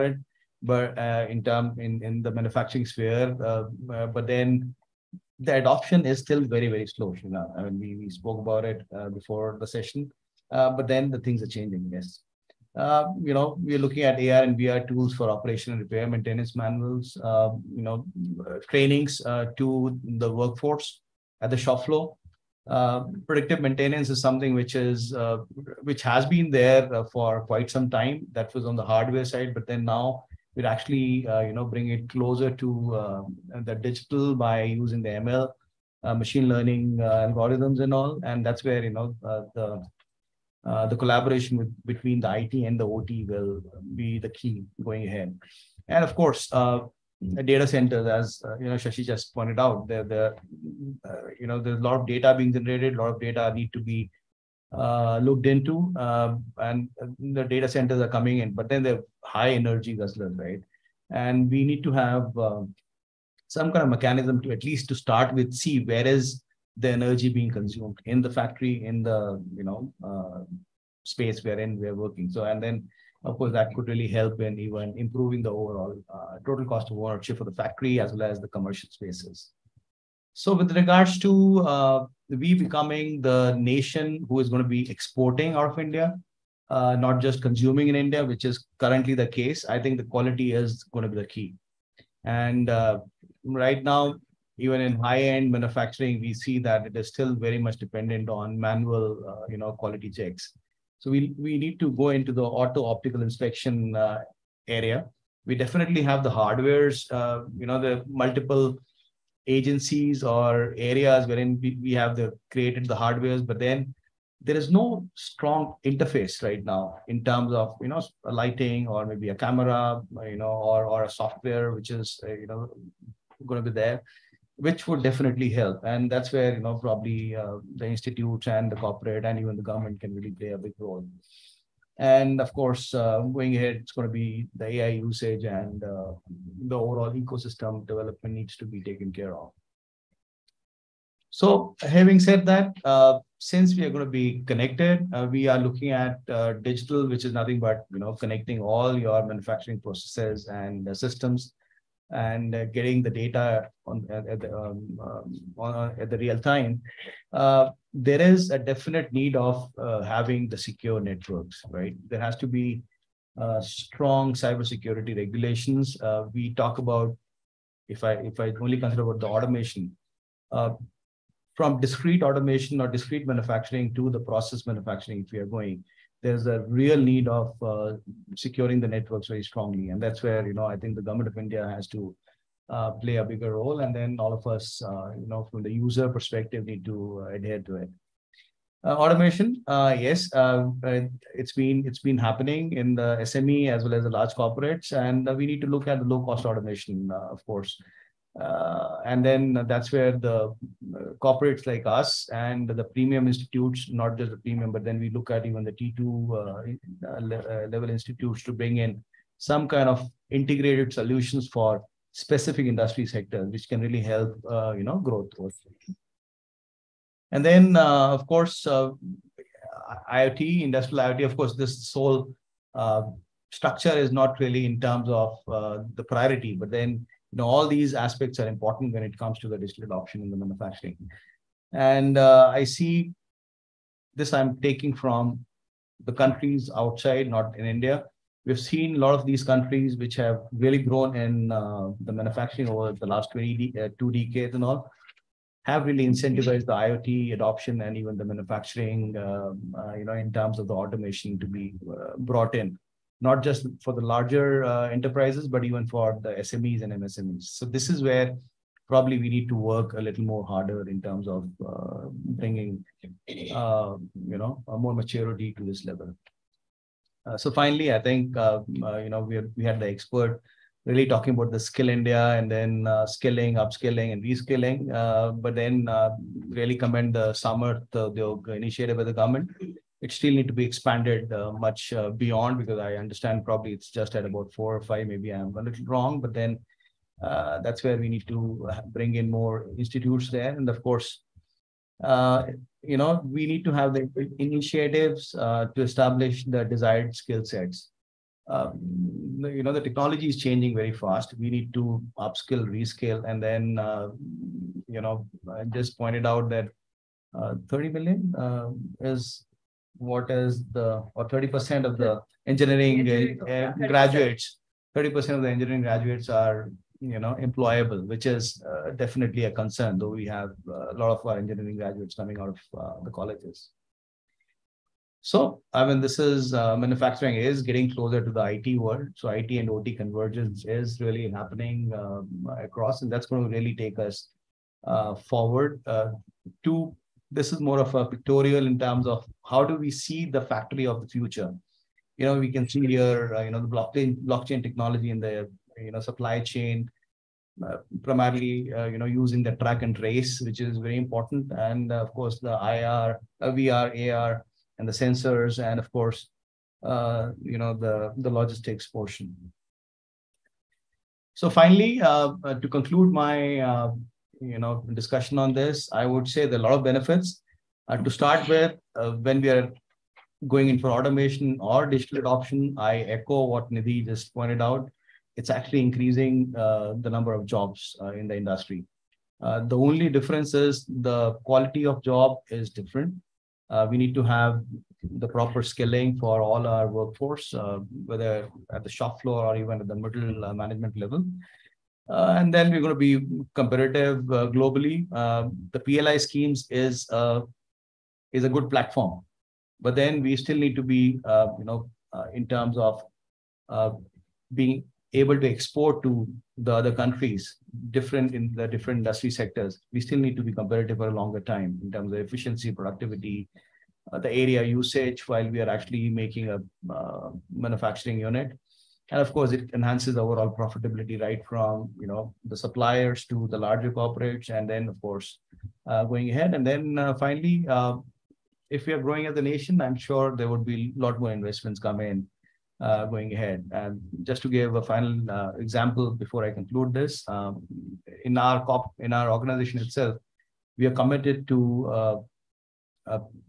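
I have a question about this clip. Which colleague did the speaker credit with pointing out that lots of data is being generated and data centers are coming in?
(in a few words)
Shashi.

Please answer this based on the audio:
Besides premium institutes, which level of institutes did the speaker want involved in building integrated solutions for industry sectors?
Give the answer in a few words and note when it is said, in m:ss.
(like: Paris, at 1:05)
T2, at 3:25.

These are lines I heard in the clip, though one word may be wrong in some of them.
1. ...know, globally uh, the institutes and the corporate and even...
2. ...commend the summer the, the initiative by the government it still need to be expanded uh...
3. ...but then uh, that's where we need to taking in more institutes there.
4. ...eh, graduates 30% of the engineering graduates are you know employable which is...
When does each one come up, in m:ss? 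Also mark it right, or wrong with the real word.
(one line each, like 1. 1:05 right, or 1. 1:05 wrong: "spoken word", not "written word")
1. 2:06 wrong: "probably", not "globally"
2. 4:36 right
3. 4:46 wrong: "bring", not "taking"
4. 5:13 right.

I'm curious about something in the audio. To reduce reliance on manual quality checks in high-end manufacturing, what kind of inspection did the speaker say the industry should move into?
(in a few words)
Auto optical inspection.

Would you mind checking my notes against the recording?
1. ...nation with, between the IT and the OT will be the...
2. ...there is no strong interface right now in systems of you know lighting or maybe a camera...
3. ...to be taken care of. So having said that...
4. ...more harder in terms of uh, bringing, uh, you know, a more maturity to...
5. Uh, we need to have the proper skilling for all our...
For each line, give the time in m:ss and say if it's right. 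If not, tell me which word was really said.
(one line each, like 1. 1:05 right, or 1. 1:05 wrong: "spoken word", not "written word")
1. 0:40 wrong: "collaboration", not "nation"
2. 1:54 wrong: "terms", not "systems"
3. 2:18 right
4. 4:20 right
5. 6:23 right.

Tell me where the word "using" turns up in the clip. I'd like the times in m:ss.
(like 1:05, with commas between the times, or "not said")
0:34, 5:49.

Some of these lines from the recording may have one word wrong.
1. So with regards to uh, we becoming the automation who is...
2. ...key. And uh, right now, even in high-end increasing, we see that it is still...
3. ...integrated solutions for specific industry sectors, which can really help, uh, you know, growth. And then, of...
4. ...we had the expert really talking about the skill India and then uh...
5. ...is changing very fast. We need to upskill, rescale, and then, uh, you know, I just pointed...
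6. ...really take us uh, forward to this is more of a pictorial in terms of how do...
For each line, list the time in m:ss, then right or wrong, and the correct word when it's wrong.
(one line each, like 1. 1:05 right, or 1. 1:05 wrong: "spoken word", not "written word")
1. 1:20 wrong: "nation", not "automation"
2. 1:31 wrong: "manufacturing", not "increasing"
3. 3:30 right
4. 4:29 right
5. 5:00 right
6. 5:33 right.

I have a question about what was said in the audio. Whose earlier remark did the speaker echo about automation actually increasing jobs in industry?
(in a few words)
Nidhi.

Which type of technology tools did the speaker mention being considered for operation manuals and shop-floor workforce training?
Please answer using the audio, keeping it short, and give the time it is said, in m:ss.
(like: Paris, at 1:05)
AR and VR, at 0:14.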